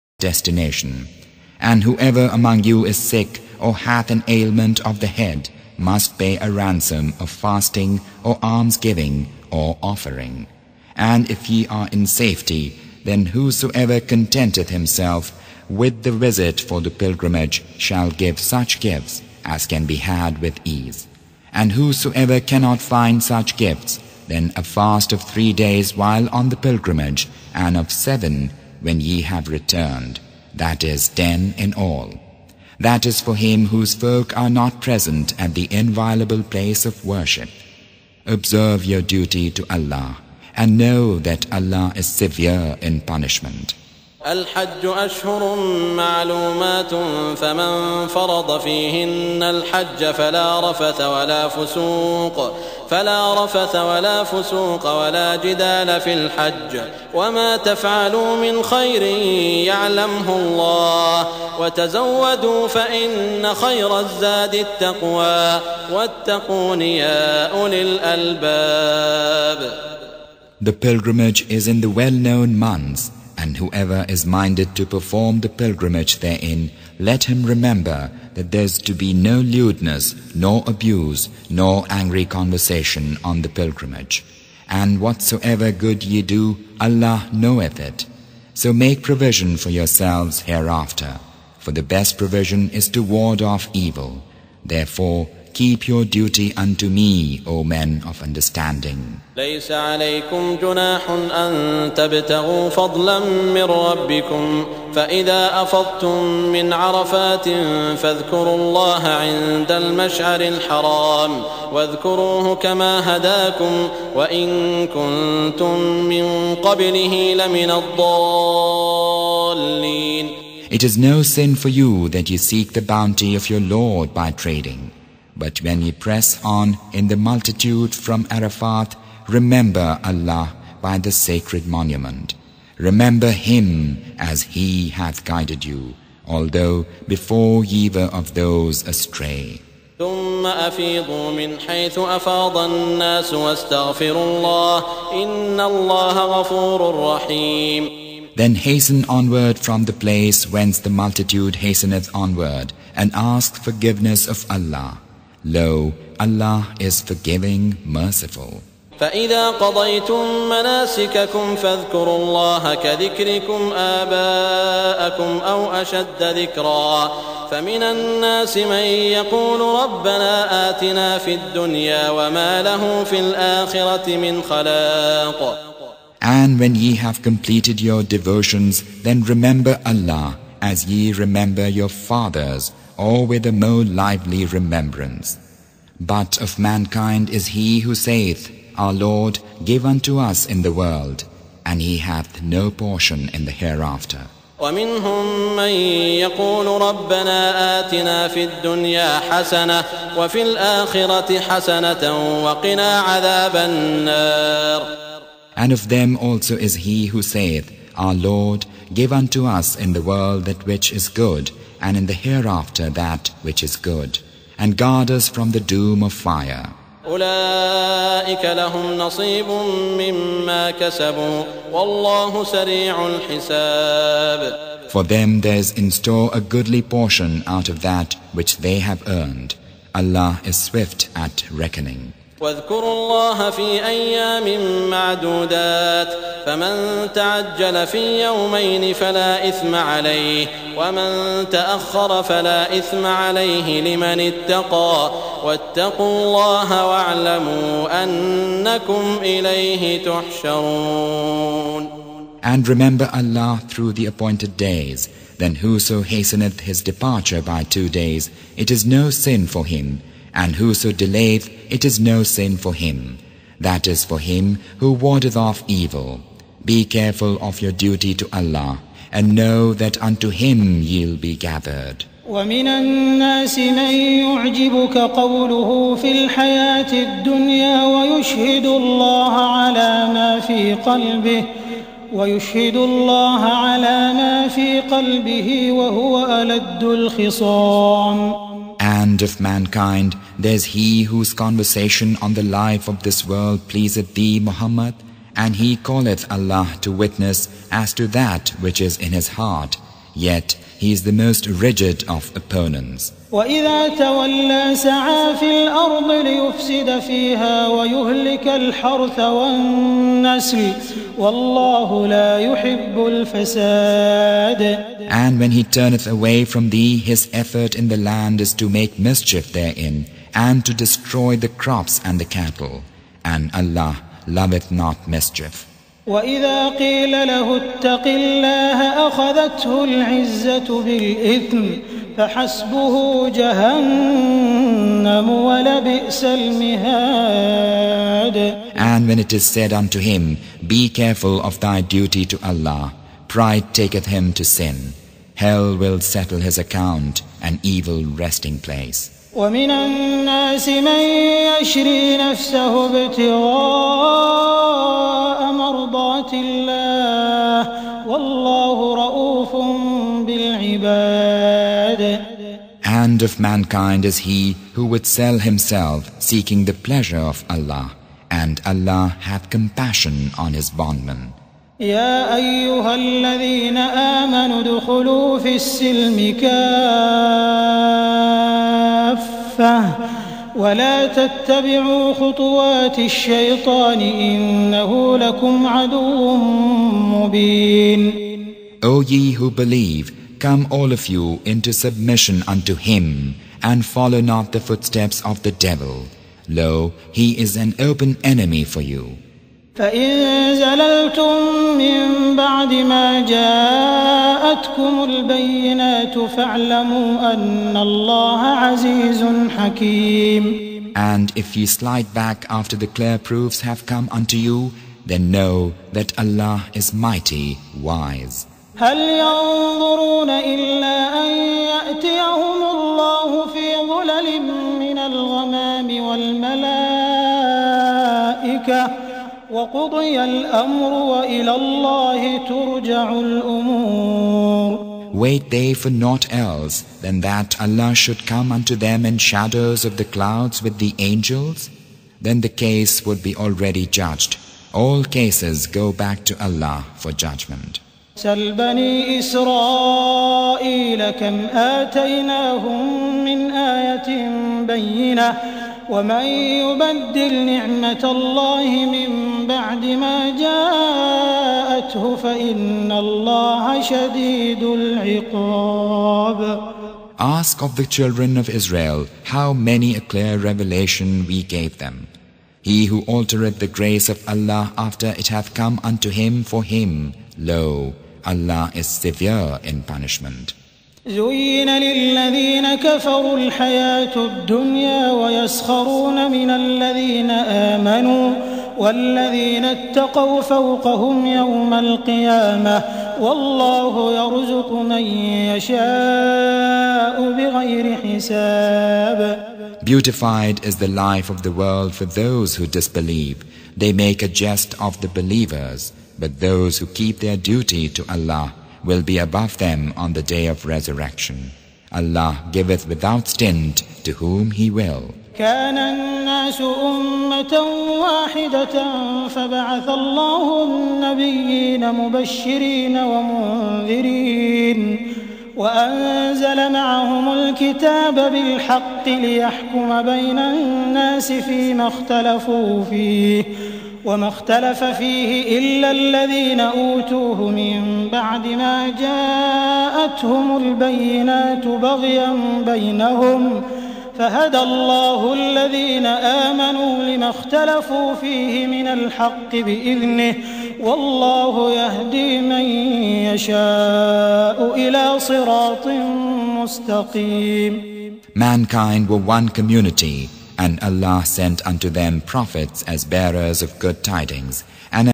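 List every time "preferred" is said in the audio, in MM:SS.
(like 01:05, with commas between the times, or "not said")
not said.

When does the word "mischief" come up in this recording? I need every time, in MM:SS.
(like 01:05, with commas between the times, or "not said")
05:18, 05:25.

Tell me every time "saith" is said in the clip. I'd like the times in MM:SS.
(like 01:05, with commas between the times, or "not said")
03:07, 03:27.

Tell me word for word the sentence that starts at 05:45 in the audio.
Hell will settle his account, an evil resting place.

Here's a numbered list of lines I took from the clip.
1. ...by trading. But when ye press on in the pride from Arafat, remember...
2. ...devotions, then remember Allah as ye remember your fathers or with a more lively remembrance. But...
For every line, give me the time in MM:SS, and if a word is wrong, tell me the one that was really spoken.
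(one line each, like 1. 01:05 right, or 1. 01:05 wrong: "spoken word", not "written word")
1. 02:04 wrong: "multitude", not "pride"
2. 02:58 right.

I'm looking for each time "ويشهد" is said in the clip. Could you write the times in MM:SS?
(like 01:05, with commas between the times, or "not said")
04:37, 04:42.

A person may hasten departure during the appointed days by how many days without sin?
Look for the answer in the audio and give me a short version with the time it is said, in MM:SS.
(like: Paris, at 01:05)
2, at 04:17.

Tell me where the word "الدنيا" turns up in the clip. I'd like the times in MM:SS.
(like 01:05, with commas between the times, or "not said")
02:51, 03:18, 04:36, 08:04.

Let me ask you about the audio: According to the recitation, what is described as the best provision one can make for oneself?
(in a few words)
to ward off evil.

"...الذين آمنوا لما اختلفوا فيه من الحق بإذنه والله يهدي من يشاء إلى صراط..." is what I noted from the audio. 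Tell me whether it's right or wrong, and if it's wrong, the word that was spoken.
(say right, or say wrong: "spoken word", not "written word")
right.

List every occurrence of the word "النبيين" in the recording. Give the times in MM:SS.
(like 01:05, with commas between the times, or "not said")
08:40.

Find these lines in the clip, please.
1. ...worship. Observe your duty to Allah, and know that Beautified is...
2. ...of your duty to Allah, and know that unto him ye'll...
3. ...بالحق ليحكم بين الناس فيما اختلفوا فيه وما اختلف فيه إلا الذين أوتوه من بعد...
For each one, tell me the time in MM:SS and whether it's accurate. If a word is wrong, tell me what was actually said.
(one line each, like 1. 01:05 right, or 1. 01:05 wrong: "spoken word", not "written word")
1. 00:37 wrong: "Allah", not "Beautified"
2. 04:27 right
3. 08:48 right.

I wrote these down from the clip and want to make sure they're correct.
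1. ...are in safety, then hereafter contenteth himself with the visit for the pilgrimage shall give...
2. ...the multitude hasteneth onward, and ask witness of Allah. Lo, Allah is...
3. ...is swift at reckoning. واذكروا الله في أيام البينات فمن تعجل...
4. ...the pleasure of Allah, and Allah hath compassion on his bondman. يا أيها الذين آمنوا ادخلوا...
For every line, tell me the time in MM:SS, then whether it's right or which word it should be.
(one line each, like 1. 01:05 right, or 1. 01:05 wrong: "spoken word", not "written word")
1. 00:11 wrong: "whosoever", not "hereafter"
2. 02:30 wrong: "forgiveness", not "witness"
3. 03:50 wrong: "معدودات", not "البينات"
4. 06:06 right.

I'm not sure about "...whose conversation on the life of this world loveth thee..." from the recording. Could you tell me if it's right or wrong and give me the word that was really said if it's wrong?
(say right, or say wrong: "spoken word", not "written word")
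wrong: "pleaseth", not "loveth".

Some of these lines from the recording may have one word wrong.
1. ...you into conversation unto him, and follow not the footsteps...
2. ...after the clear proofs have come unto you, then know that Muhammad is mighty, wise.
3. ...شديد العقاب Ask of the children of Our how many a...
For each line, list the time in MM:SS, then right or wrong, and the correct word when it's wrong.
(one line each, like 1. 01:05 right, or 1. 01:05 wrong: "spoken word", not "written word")
1. 06:31 wrong: "submission", not "conversation"
2. 06:52 wrong: "Allah", not "Muhammad"
3. 07:43 wrong: "Israel", not "Our".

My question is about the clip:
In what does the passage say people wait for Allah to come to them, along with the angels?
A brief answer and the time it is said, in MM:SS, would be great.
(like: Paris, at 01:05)
shadows of the clouds, at 07:19.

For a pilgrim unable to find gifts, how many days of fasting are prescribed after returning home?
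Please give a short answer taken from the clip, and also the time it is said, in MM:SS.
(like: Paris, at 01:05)
7, at 00:27.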